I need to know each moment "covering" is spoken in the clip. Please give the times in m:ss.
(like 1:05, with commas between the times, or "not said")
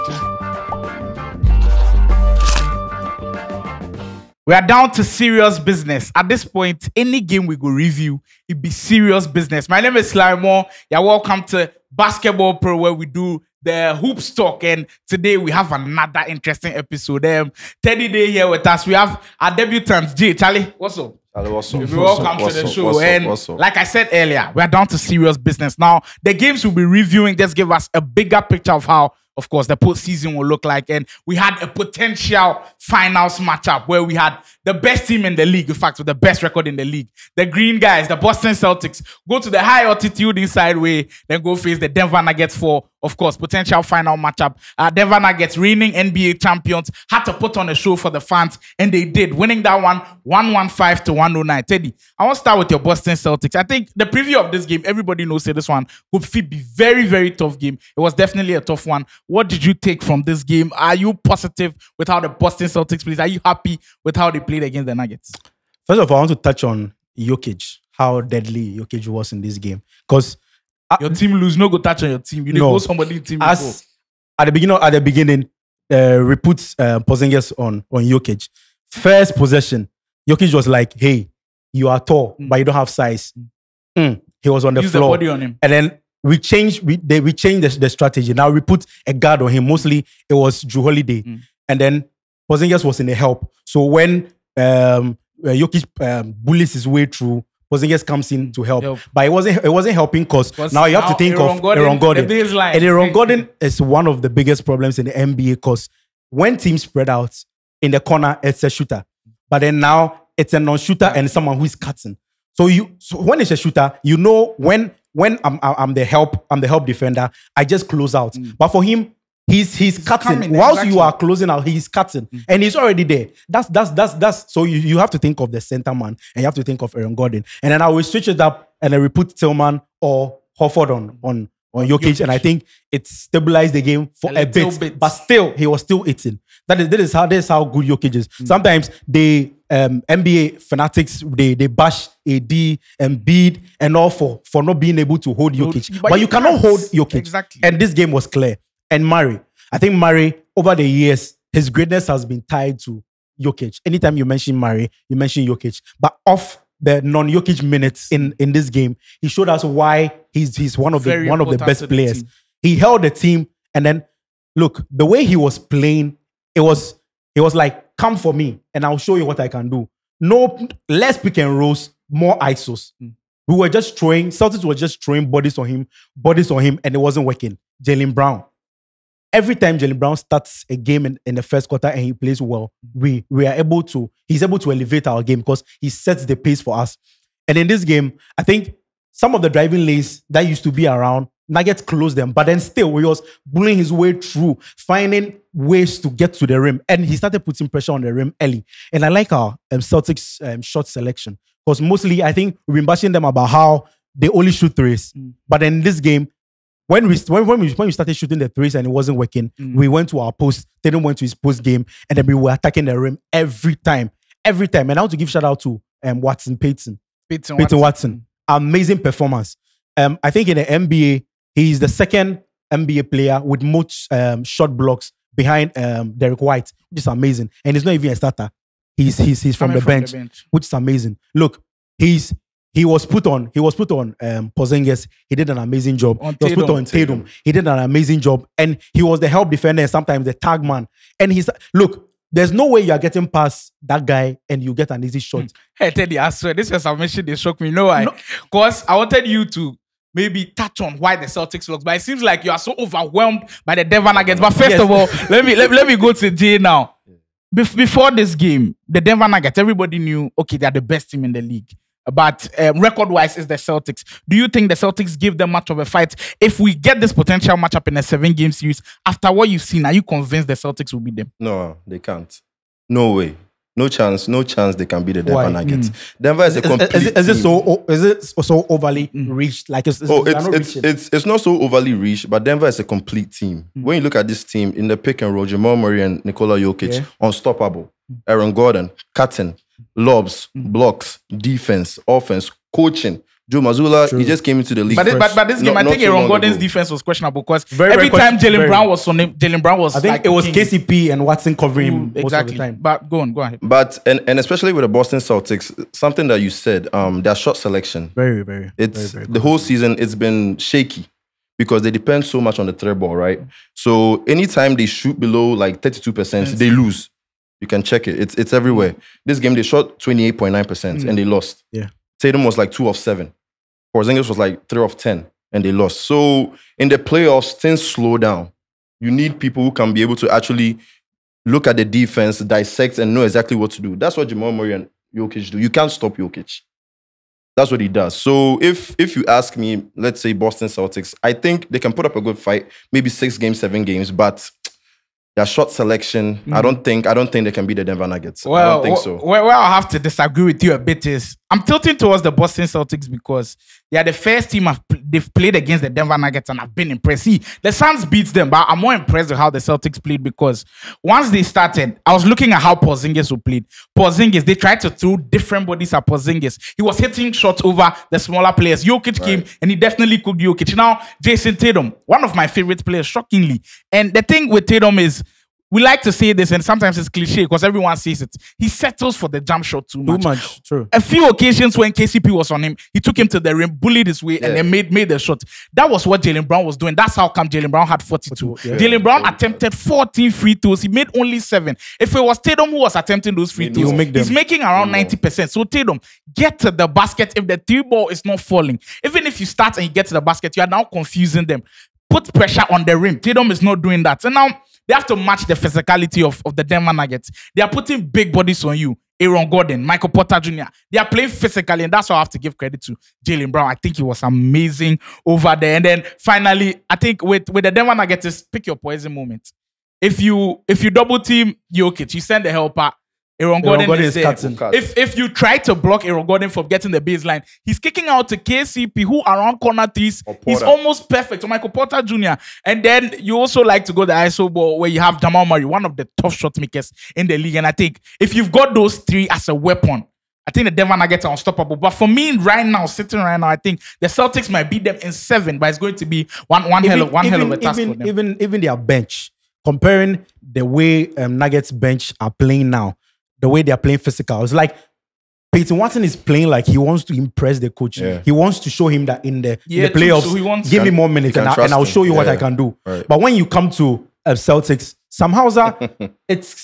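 5:01.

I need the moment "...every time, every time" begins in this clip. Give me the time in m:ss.
3:33.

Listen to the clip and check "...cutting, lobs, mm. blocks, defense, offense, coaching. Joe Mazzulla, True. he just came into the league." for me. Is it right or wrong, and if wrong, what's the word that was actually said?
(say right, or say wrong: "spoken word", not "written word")
right.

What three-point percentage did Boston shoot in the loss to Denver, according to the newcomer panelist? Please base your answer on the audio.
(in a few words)
28.9%.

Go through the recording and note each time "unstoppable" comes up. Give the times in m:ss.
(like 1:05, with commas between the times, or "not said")
4:47, 7:21.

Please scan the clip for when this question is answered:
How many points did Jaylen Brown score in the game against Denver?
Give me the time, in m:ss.
6:28.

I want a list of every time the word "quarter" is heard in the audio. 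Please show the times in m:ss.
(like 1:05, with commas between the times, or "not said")
3:01.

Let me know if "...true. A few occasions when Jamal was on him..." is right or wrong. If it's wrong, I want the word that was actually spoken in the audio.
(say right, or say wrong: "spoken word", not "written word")
wrong: "KCP", not "Jamal".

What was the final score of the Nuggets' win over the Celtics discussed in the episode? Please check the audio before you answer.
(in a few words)
115 to 109.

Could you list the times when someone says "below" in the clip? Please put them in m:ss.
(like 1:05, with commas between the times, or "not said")
5:15.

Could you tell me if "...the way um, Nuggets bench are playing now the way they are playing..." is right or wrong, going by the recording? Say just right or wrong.
right.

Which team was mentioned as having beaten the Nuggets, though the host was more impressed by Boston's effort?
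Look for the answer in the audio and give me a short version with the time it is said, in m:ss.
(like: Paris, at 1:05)
Suns, at 5:57.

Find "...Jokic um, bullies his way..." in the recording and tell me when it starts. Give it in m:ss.
1:35.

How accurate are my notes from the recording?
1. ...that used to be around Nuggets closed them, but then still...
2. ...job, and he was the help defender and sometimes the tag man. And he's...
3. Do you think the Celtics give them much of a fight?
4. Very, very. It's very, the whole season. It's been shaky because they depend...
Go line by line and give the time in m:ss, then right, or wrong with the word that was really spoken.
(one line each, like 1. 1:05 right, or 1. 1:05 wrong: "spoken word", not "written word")
1. 3:10 right
2. 3:58 right
3. 4:24 right
4. 5:08 right.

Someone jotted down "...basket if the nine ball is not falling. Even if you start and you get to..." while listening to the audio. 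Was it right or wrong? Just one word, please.
wrong.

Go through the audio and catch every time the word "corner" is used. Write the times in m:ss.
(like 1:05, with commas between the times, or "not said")
1:47, 7:09.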